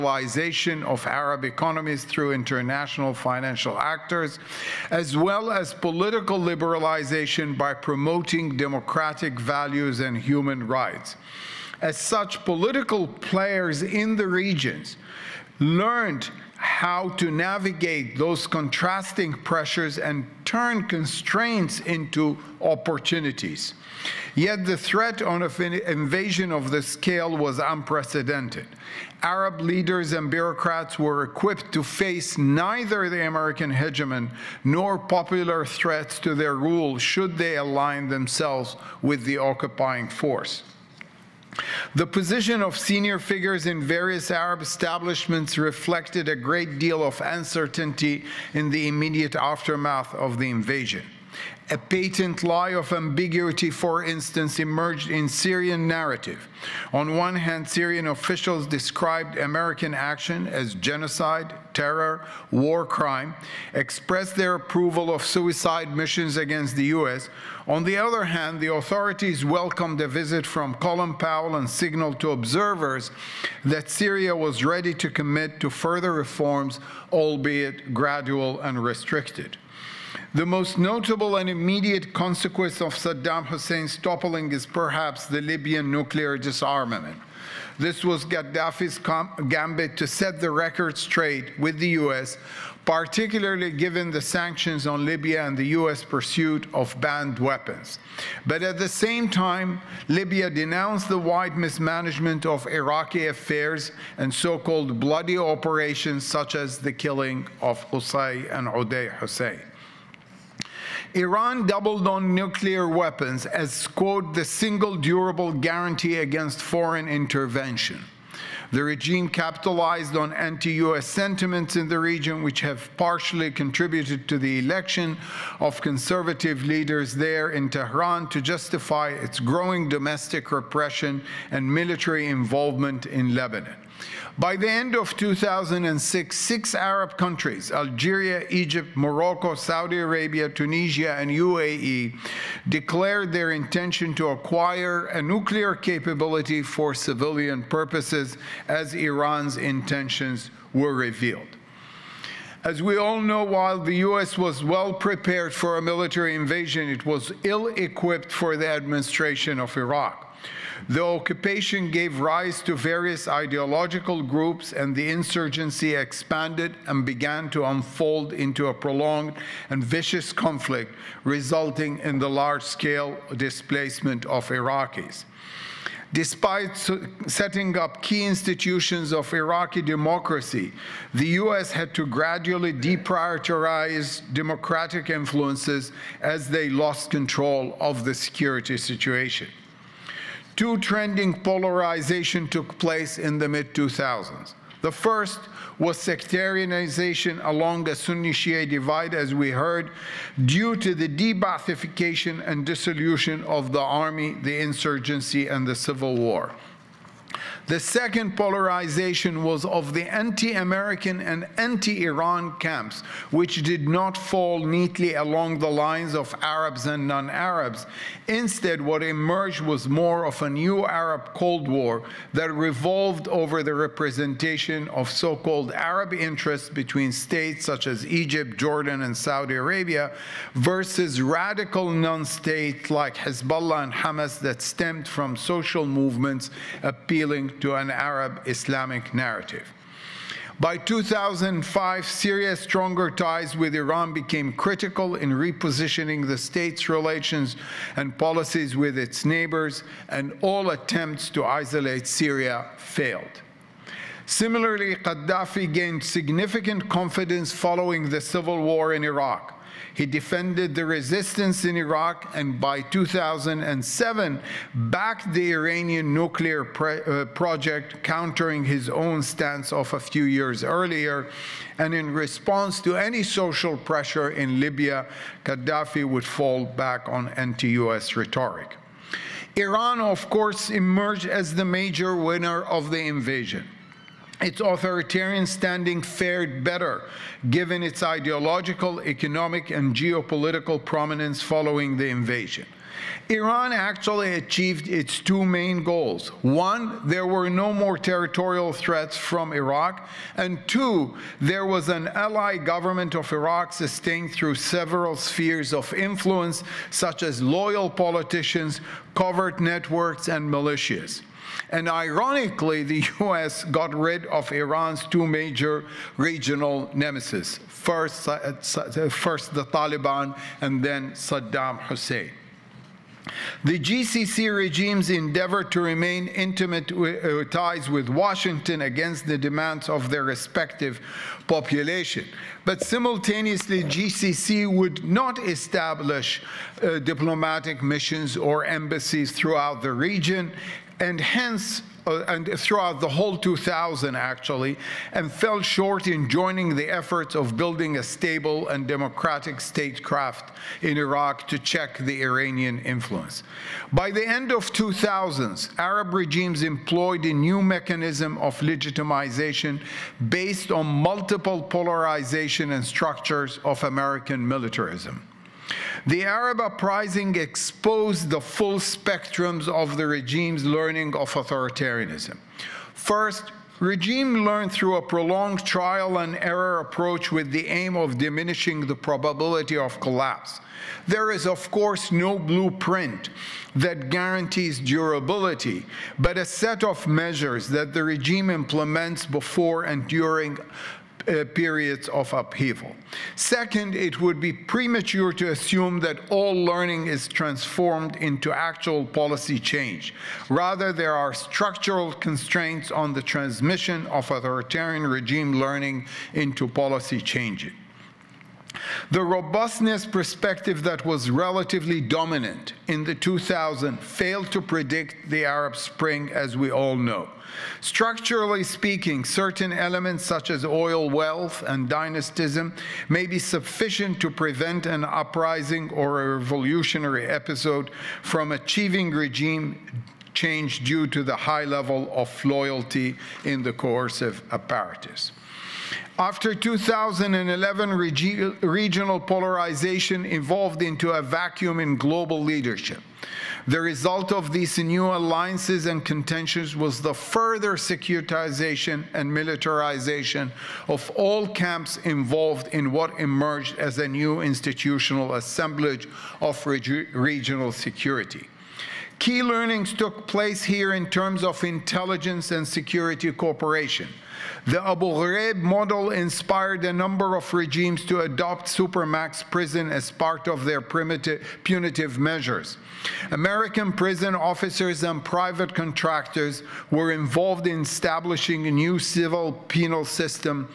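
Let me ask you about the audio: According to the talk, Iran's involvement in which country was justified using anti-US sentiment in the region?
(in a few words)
Lebanon.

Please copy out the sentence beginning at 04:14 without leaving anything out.
Similarly, Gaddafi gained significant confidence following the civil war in Iraq.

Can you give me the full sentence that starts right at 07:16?
After 2011, regional polarization evolved into a vacuum in global leadership.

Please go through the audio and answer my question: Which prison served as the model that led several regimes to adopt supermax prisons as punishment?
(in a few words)
Abu Ghraib.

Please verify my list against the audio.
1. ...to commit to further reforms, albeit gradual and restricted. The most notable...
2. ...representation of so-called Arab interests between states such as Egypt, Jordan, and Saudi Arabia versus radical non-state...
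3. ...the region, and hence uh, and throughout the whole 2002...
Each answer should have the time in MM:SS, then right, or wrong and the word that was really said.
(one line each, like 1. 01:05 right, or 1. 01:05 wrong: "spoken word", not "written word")
1. 01:14 right
2. 03:43 right
3. 05:39 wrong: "2000", not "2002".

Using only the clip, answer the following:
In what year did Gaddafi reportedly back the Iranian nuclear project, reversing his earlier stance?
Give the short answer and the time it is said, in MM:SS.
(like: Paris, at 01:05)
2007, at 04:22.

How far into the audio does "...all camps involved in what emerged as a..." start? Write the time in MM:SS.
07:31.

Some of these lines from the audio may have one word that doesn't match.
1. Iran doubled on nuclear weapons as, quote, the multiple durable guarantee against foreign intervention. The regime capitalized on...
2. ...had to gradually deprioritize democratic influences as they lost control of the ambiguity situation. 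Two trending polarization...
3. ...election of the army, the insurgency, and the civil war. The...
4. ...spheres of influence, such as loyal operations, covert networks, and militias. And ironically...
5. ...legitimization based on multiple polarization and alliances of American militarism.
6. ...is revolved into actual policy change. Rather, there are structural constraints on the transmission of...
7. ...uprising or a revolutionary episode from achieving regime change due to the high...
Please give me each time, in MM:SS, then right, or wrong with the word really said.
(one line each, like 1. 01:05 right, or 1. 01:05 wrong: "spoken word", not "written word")
1. 01:51 wrong: "single", not "multiple"
2. 03:01 wrong: "security", not "ambiguity"
3. 03:22 wrong: "dissolution", not "election"
4. 05:05 wrong: "politicians", not "operations"
5. 05:58 wrong: "structures", not "alliances"
6. 06:37 wrong: "transformed", not "revolved"
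7. 07:05 right.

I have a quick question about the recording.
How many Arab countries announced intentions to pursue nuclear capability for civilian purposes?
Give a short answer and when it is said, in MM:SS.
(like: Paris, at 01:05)
6, at 02:16.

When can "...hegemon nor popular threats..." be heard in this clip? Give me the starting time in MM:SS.
00:33.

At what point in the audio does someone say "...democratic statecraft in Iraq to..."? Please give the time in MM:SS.
05:48.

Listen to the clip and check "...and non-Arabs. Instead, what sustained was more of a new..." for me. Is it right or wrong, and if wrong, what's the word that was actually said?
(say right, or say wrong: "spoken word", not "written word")
wrong: "emerged", not "sustained".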